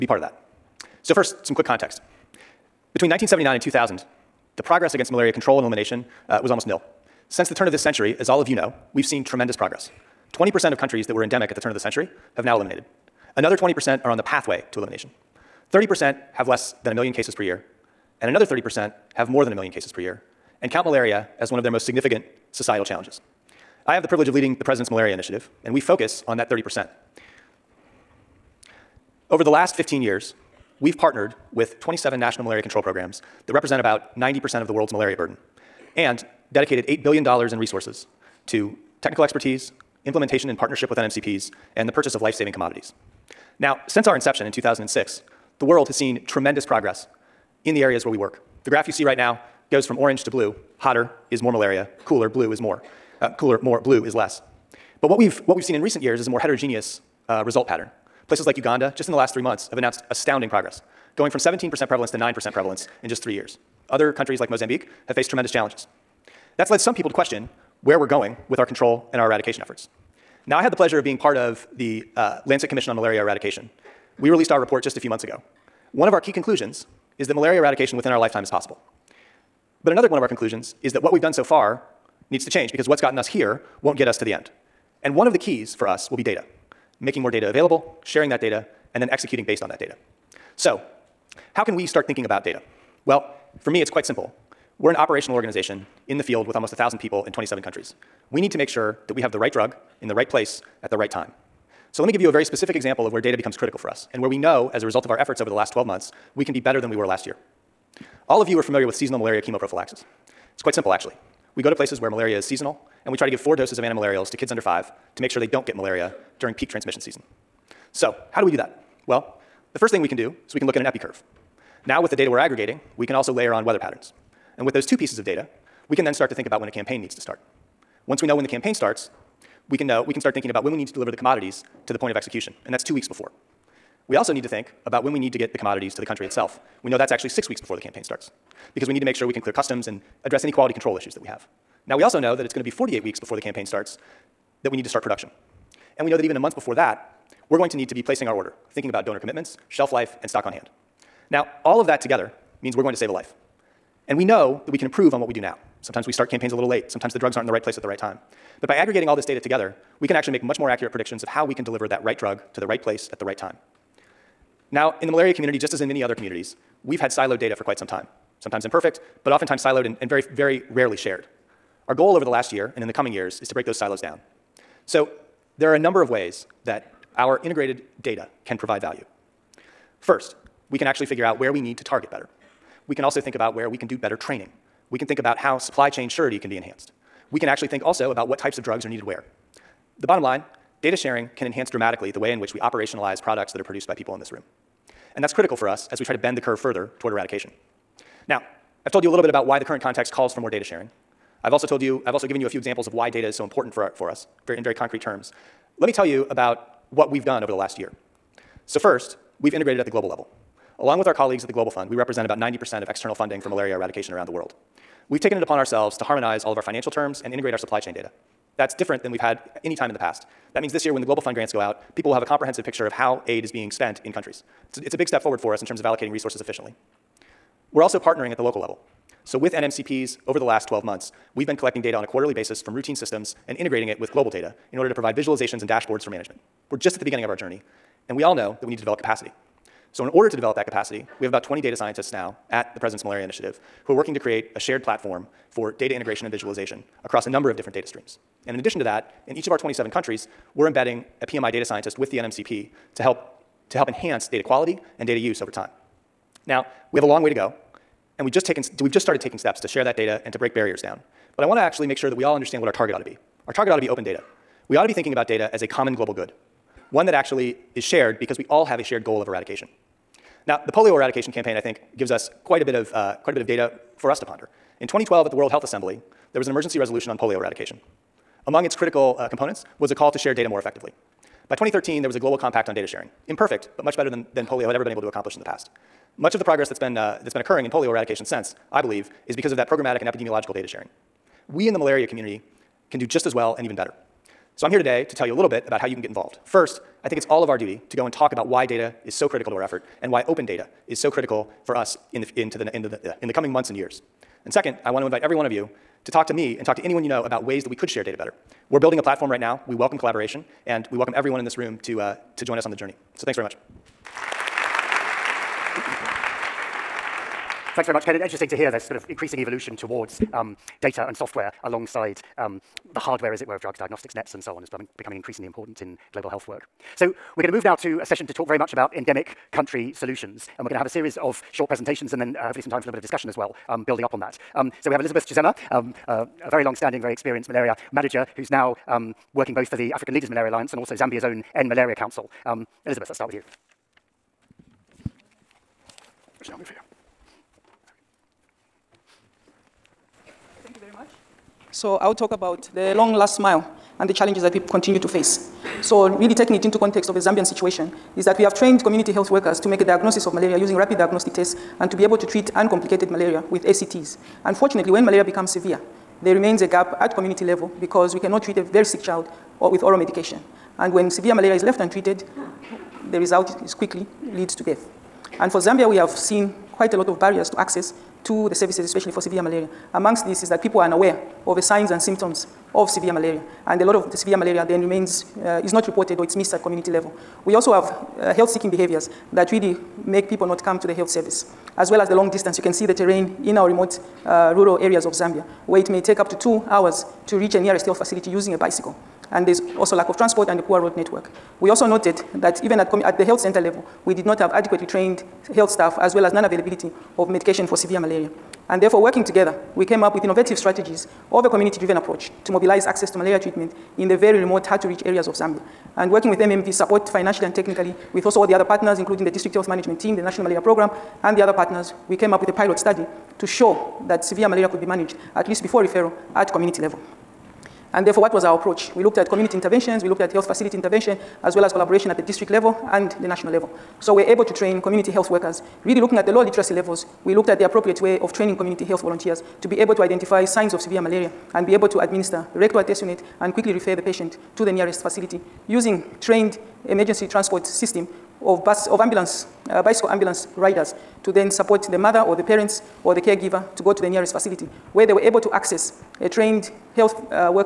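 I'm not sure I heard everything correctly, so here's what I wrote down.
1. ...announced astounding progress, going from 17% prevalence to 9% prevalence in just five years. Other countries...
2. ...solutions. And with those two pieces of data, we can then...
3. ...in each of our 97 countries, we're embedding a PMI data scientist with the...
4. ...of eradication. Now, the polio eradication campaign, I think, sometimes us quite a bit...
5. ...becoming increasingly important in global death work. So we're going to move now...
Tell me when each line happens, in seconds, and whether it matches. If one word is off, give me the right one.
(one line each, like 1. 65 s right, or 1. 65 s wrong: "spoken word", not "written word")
1. 59 s wrong: "three", not "five"
2. 123 s wrong: "patterns", not "solutions"
3. 249 s wrong: "27", not "97"
4. 269 s wrong: "gives", not "sometimes"
5. 324 s wrong: "health", not "death".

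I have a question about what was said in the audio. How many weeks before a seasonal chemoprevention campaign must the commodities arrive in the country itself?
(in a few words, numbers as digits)
6 weeks.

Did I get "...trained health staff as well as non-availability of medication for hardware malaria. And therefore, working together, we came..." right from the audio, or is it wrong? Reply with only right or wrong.
wrong.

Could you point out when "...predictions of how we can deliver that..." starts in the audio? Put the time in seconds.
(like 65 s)
160 s.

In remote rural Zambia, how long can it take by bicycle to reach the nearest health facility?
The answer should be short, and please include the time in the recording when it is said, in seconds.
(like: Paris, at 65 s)
2 hours, at 396 s.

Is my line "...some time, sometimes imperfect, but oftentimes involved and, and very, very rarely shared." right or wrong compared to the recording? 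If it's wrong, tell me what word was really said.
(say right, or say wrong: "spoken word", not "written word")
wrong: "siloed", not "involved".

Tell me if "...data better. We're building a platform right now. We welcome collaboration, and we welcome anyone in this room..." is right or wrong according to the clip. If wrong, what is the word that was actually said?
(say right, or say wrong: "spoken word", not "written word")
wrong: "everyone", not "anyone".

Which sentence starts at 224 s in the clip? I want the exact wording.
It's a, it's a big step forward for us in terms of allocating resources efficiently.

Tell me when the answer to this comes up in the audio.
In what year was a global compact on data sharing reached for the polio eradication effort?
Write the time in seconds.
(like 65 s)
281 s.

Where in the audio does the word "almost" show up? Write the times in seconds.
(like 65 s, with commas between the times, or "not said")
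6 s, 96 s.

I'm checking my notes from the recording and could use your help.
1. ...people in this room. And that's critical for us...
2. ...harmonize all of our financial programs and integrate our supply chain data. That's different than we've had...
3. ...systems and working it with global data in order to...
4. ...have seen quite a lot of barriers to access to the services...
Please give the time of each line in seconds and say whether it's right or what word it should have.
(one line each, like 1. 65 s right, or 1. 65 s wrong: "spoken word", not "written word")
1. 193 s right
2. 216 s wrong: "terms", not "programs"
3. 232 s wrong: "integrating", not "working"
4. 375 s right.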